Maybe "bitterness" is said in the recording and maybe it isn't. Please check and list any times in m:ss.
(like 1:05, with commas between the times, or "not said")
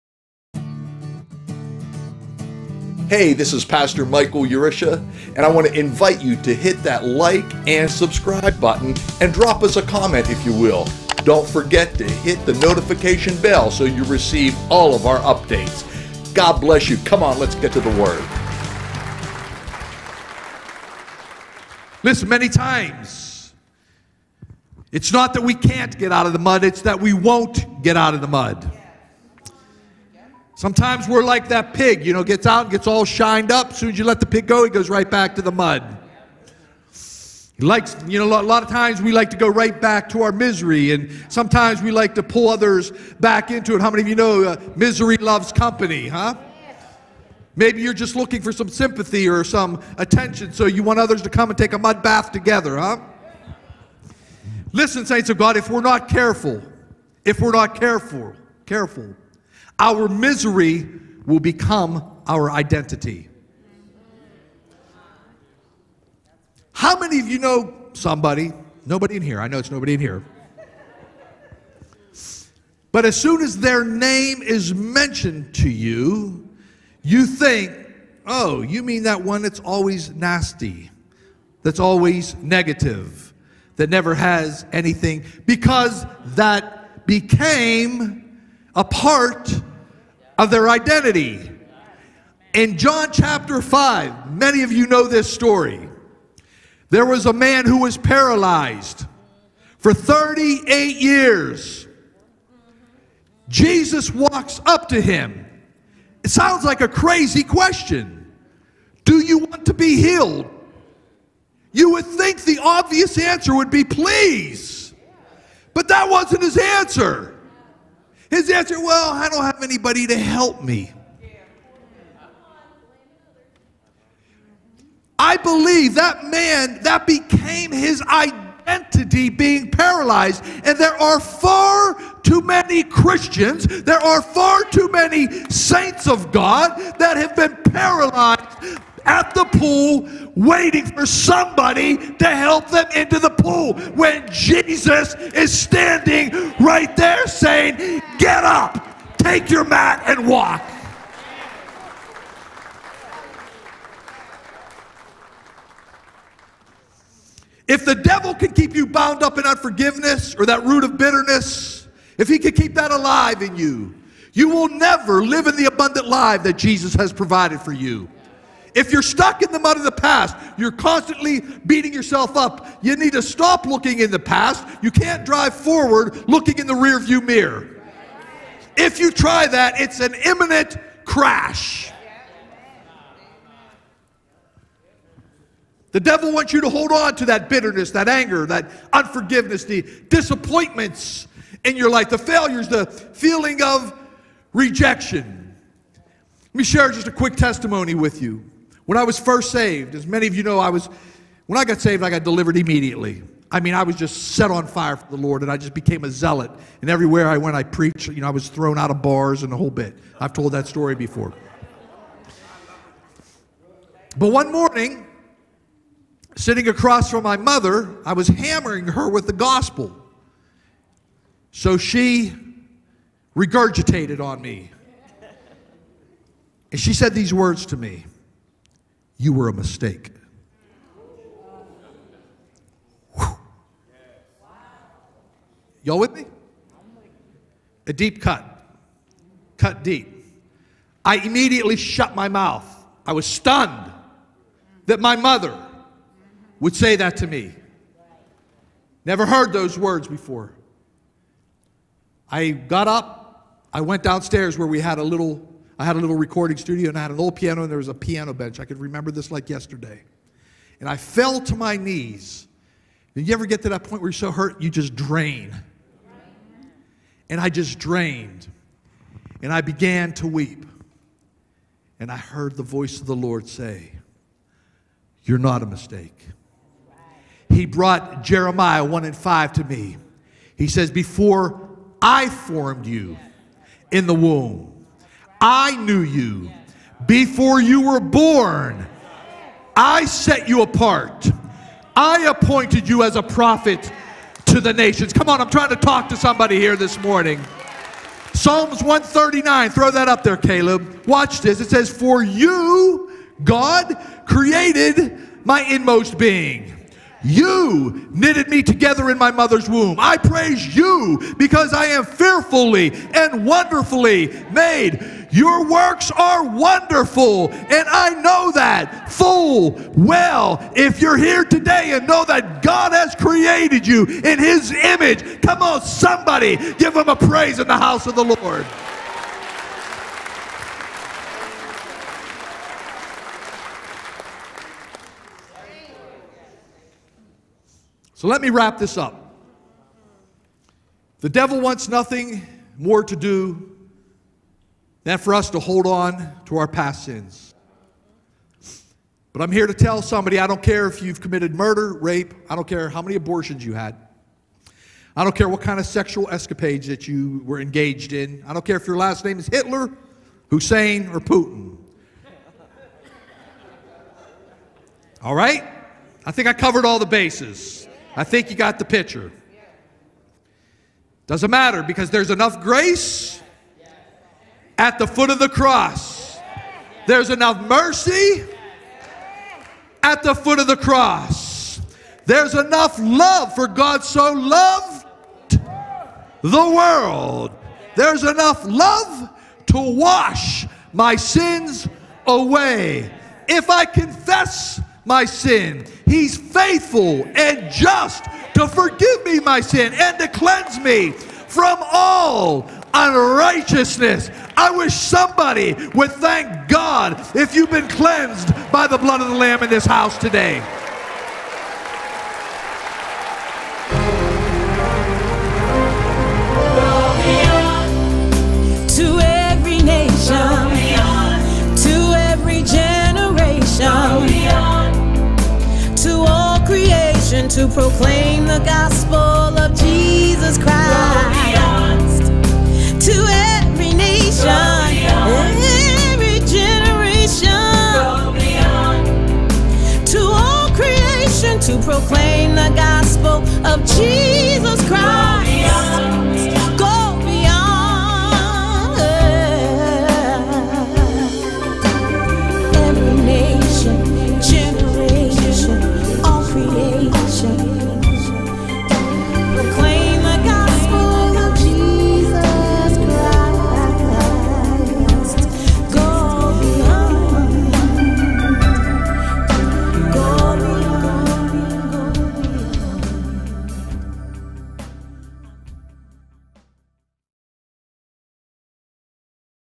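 2:40, 3:07.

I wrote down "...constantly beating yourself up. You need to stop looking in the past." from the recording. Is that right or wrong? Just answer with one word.
right.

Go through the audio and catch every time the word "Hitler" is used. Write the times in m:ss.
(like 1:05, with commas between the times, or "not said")
5:59.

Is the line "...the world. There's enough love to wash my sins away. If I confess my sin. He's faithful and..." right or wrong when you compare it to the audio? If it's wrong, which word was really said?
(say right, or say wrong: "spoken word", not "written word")
right.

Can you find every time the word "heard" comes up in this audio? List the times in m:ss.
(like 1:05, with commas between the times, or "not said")
4:09, 4:32.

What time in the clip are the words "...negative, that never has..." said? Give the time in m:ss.
1:22.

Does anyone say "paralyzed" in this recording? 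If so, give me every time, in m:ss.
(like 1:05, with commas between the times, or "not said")
1:37, 2:09, 2:17.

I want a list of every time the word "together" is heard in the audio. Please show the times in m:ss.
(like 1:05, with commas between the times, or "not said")
0:52, 5:08.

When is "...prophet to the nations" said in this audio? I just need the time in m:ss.
4:53.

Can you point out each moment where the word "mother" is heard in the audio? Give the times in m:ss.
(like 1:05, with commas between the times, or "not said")
3:37, 4:05, 5:09.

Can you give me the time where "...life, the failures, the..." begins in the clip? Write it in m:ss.
3:11.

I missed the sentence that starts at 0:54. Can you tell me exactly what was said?
Listen, saints of God, if we're not careful, if we're not careful, careful, our misery will become our identity.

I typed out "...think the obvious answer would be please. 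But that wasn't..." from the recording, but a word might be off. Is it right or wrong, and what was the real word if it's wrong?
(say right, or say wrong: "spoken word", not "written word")
right.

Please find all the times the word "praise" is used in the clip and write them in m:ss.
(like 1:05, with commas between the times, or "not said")
5:10, 5:27.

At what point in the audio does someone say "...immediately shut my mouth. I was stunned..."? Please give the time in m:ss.
4:01.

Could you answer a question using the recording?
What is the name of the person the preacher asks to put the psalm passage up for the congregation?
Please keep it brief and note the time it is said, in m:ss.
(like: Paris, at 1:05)
Caleb, at 5:00.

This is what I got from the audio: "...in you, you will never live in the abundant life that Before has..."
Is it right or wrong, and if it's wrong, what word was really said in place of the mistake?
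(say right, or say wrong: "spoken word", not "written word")
wrong: "Jesus", not "Before".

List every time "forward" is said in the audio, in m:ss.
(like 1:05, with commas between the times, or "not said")
2:55.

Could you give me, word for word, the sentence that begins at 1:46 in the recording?
It sounds like a crazy question.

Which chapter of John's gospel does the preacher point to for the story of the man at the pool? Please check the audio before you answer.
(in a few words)
John chapter 5.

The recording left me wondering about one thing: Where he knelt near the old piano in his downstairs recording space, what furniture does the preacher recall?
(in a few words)
Piano bench.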